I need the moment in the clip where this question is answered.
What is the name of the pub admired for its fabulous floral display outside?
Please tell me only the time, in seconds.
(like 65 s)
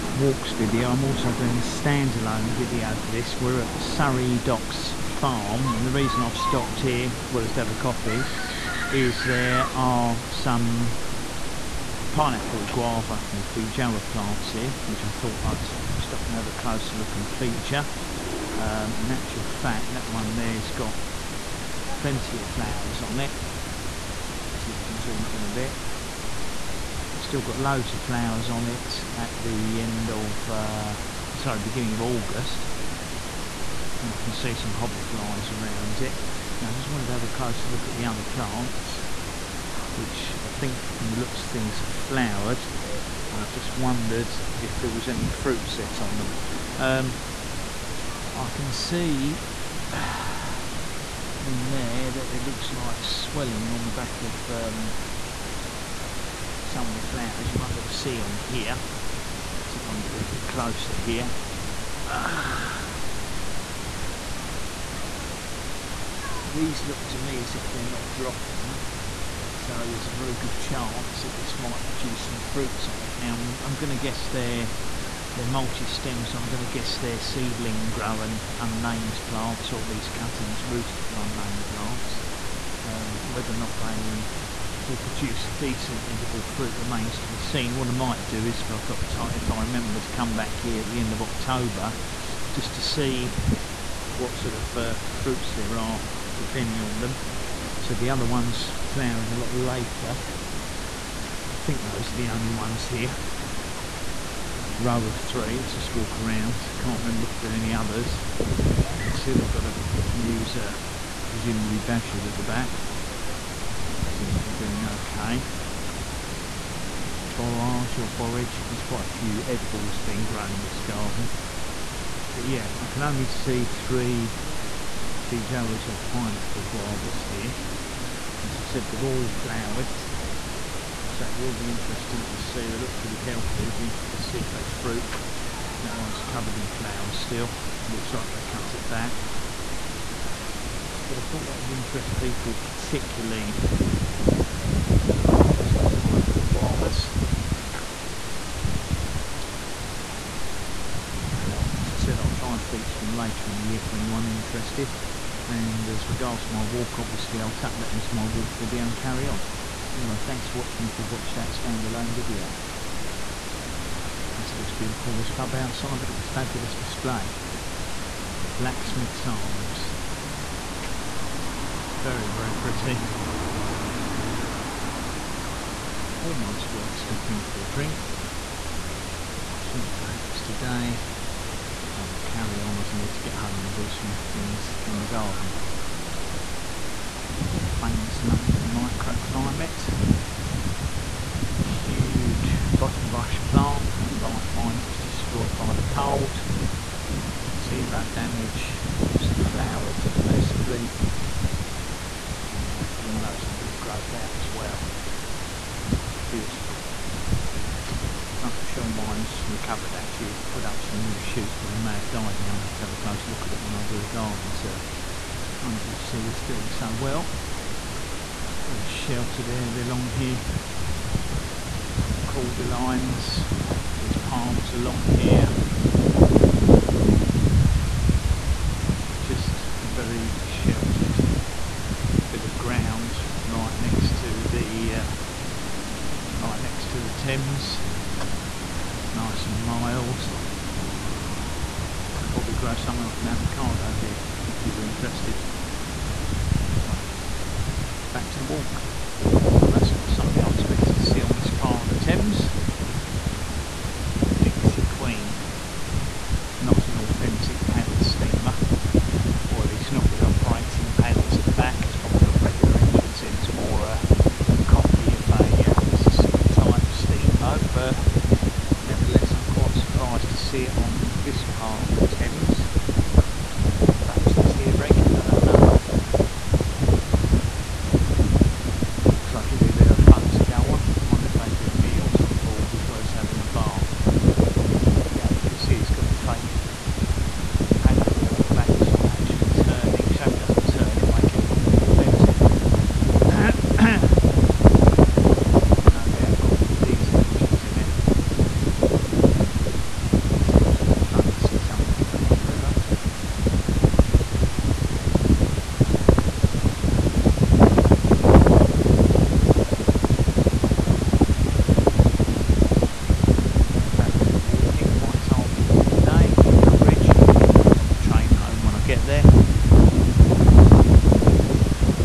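168 s.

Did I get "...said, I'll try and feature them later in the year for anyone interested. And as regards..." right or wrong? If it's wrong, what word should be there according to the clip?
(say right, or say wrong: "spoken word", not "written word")
right.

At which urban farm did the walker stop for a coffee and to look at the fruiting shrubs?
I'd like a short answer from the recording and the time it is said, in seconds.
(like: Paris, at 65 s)
Surrey Docks Farm, at 3 s.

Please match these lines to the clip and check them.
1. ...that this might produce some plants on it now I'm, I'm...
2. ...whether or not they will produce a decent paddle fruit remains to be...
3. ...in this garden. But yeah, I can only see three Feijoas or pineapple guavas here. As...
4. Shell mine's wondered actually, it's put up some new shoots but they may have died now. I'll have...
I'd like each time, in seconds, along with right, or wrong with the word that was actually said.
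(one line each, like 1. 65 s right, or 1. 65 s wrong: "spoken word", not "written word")
1. 71 s wrong: "fruits", not "plants"
2. 83 s wrong: "edible", not "paddle"
3. 120 s right
4. 208 s wrong: "recovered", not "wondered".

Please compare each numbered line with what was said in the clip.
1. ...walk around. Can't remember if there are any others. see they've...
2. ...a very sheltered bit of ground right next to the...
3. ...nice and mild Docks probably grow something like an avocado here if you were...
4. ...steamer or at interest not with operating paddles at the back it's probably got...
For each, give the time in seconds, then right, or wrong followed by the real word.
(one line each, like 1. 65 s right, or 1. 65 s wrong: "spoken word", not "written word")
1. 105 s right
2. 229 s right
3. 239 s wrong: "Could", not "Docks"
4. 258 s wrong: "least", not "interest".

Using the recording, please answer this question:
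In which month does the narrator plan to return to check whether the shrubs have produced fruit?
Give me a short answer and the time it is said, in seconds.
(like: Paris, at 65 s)
October, at 91 s.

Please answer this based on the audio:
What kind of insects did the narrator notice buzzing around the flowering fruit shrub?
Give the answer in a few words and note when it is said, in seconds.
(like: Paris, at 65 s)
hoverflies, at 34 s.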